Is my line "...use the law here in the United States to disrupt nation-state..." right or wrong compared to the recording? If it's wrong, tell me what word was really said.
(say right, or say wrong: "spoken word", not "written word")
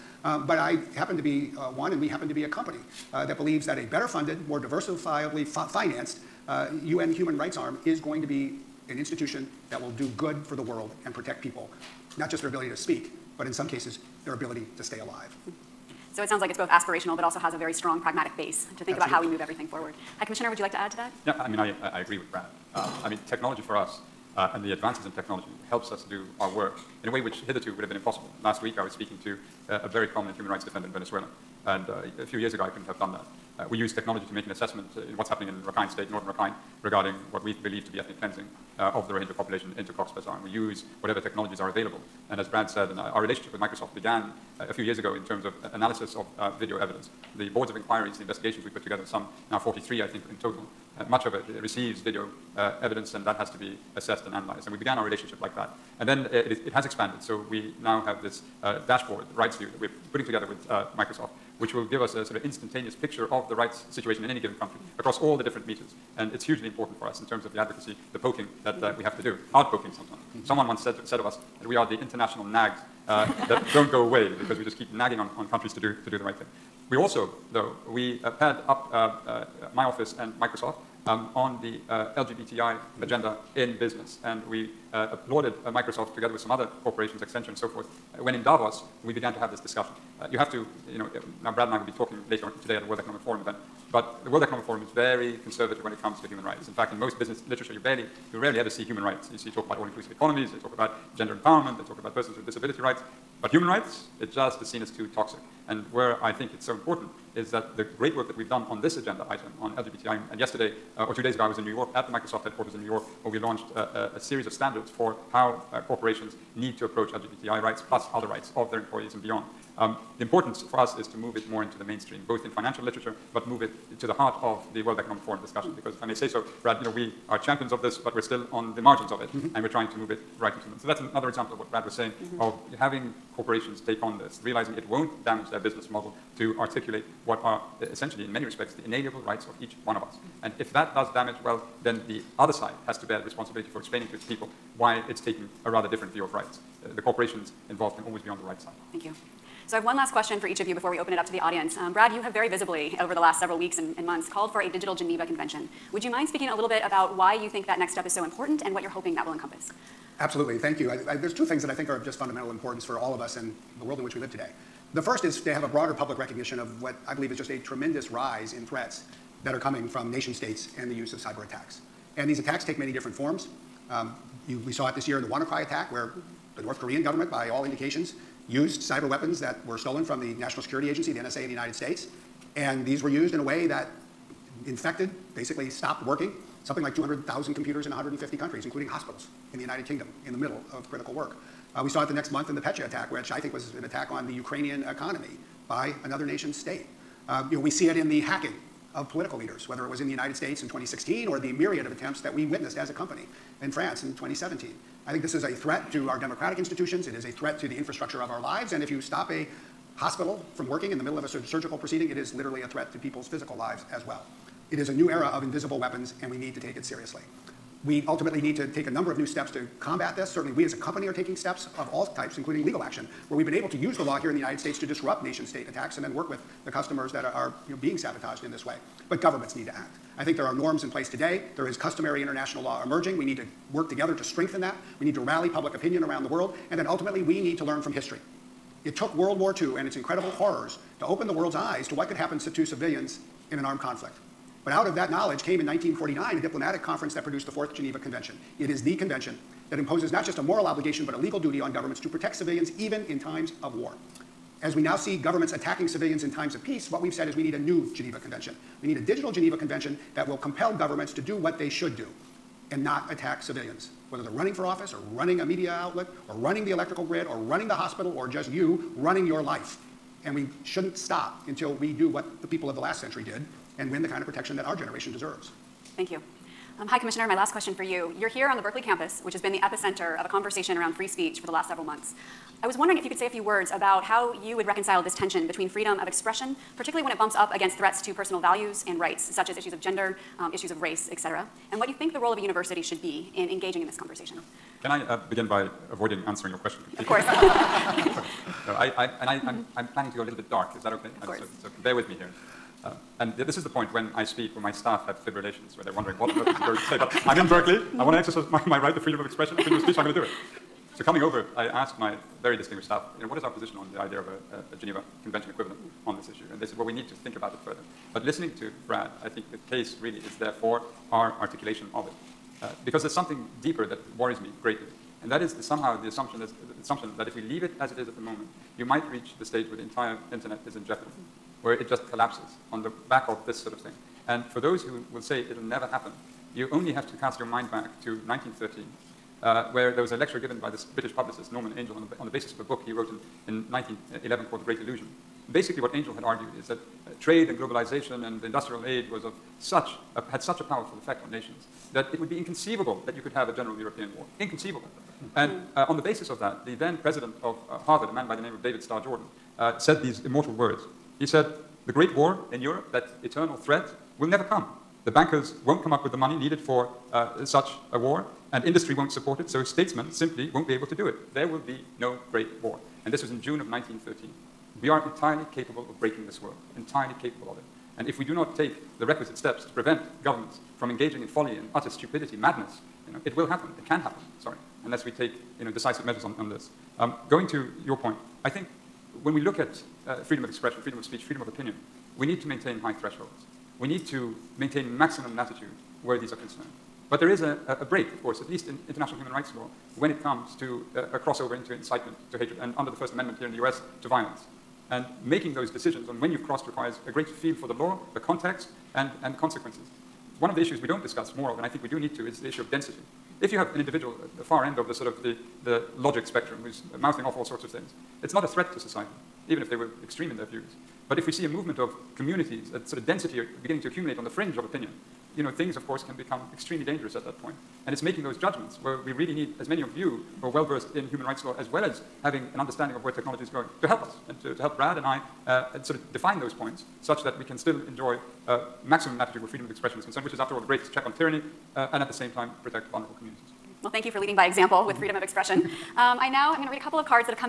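right.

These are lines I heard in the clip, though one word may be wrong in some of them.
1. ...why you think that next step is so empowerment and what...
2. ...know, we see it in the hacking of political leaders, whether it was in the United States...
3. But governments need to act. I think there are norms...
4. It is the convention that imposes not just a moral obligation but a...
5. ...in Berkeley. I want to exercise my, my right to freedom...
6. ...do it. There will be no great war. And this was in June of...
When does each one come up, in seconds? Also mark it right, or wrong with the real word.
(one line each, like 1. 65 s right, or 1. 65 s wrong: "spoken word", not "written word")
1. 157 s wrong: "important", not "empowerment"
2. 197 s right
3. 229 s right
4. 248 s right
5. 307 s right
6. 370 s right.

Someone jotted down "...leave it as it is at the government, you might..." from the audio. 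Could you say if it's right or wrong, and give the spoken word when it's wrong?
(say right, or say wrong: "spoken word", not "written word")
wrong: "moment", not "government".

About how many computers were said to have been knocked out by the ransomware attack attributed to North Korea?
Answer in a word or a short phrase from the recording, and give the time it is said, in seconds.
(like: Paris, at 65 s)
200,000, at 186 s.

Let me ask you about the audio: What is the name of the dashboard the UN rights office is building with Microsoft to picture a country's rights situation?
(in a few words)
rights view.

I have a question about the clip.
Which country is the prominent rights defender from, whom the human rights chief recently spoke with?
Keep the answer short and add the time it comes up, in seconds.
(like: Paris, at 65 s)
Venezuela, at 30 s.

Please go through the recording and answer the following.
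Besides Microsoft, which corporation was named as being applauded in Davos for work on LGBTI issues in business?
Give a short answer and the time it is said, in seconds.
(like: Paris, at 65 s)
Accenture, at 87 s.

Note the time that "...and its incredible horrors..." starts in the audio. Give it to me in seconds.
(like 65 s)
239 s.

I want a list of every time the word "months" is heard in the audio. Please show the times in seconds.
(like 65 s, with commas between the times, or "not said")
154 s, 192 s, 281 s.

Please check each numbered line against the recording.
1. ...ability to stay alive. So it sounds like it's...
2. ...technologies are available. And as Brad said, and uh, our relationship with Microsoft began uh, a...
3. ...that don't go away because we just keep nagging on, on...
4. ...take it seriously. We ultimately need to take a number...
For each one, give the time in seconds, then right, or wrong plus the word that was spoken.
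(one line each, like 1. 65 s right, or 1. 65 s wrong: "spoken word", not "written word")
1. 14 s right
2. 41 s right
3. 73 s right
4. 216 s right.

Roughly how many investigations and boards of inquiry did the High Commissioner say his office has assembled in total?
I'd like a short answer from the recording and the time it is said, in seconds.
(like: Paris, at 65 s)
43, at 49 s.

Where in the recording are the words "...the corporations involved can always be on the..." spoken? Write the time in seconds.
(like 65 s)
146 s.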